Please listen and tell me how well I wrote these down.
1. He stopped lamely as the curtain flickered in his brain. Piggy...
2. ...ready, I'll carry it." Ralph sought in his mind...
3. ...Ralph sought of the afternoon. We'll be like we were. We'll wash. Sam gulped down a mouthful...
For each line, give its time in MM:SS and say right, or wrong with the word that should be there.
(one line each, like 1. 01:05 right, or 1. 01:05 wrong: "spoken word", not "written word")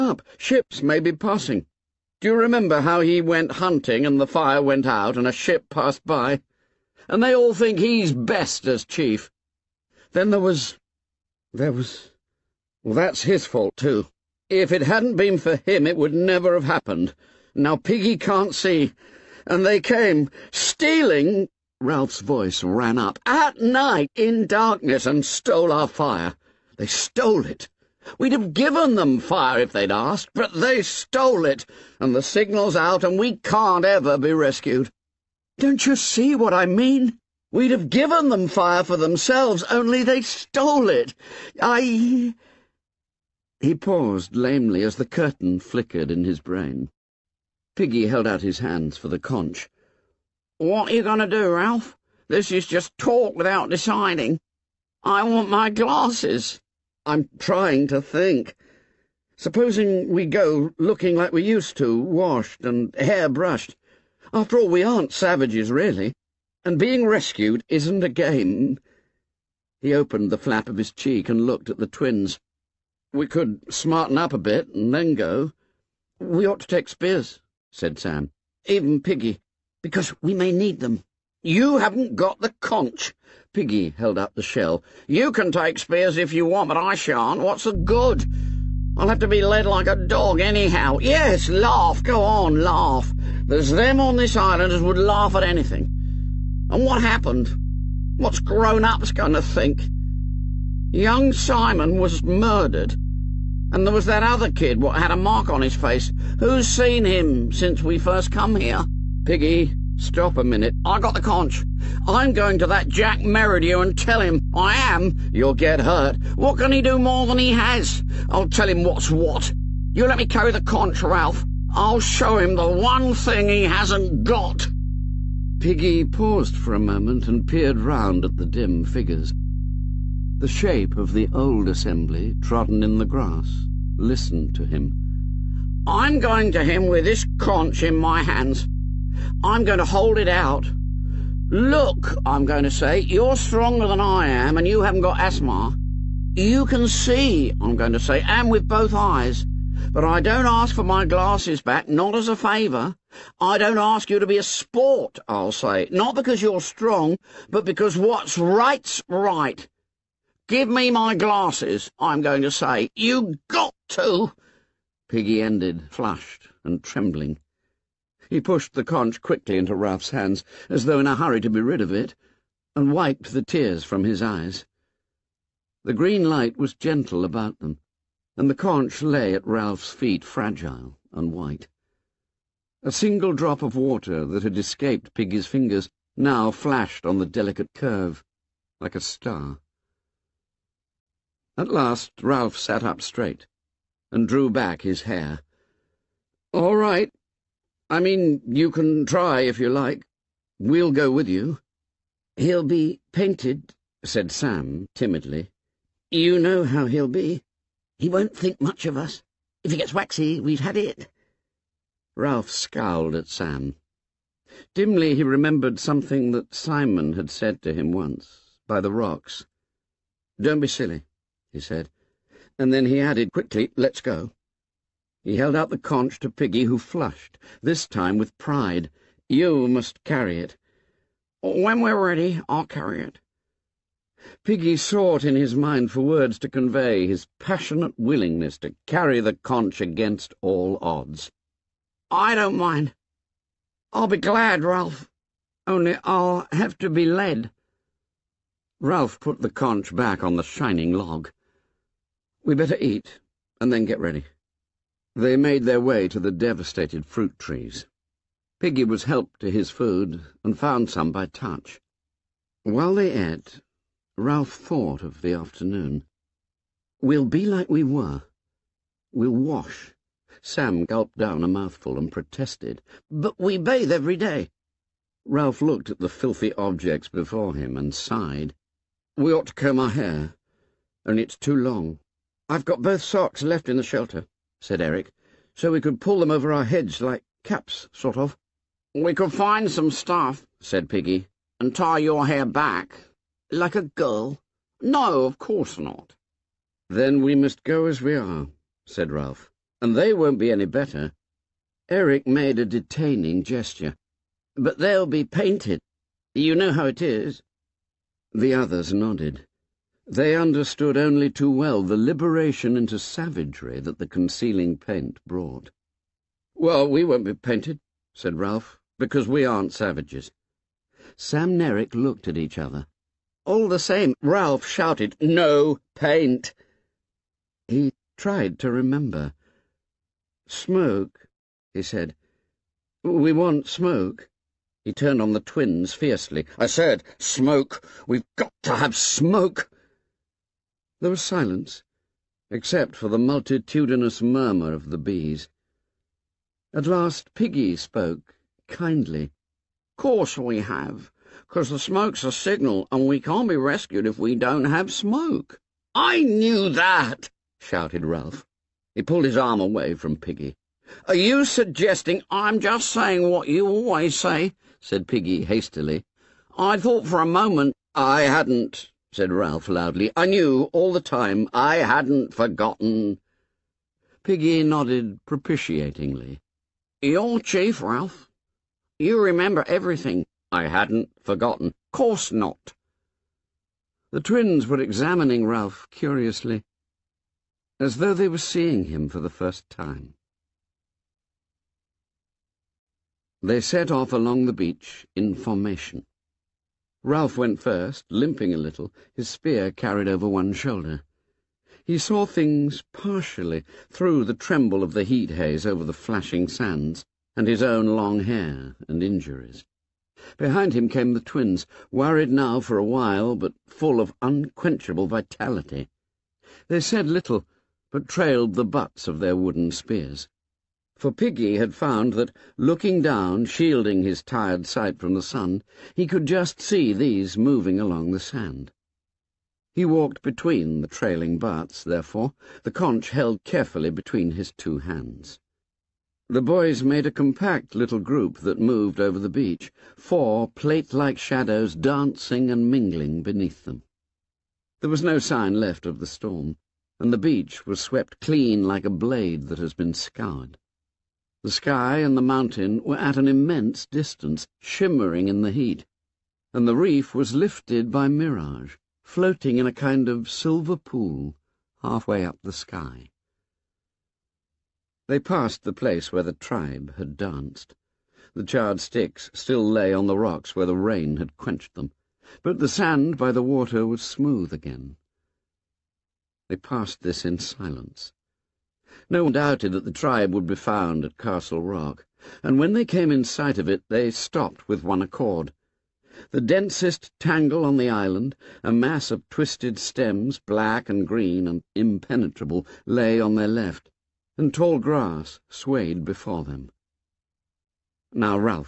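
1. 00:43 wrong: "paused", not "stopped"
2. 03:52 wrong: "Piggy", not "Ralph"
3. 04:24 wrong: "thought", not "sought".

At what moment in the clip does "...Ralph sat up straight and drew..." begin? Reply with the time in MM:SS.
03:12.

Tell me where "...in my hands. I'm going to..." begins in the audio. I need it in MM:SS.
02:17.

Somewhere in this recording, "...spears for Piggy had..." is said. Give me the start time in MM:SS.
06:59.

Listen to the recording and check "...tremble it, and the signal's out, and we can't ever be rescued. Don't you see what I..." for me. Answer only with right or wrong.
wrong.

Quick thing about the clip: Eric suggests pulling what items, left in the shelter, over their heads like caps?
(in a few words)
Socks.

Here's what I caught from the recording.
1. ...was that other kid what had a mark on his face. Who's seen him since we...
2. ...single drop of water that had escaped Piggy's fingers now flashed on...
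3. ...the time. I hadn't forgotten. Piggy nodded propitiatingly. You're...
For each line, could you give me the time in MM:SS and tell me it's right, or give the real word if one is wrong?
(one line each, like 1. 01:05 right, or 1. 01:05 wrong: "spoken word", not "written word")
1. 01:43 right
2. 03:02 right
3. 06:10 right.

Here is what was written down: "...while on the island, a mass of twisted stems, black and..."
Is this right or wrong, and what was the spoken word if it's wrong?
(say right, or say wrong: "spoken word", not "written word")
wrong: "tangle", not "while".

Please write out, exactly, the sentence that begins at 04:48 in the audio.
We could find some stuff, said Piggy, and tie your hair back.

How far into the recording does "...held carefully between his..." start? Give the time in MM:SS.
07:13.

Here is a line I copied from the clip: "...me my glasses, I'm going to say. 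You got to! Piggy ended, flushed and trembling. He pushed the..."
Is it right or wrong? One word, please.
right.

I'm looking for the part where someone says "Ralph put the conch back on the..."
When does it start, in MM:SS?
04:08.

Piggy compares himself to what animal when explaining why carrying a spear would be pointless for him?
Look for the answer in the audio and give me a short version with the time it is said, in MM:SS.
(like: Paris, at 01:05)
A dog, at 01:29.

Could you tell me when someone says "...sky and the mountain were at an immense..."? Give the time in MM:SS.
07:31.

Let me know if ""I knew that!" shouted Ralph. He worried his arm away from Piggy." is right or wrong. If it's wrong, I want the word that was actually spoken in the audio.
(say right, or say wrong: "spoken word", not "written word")
wrong: "pulled", not "worried".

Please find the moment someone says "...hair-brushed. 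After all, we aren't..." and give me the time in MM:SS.
01:02.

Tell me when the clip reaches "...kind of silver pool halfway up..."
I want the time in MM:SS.
07:39.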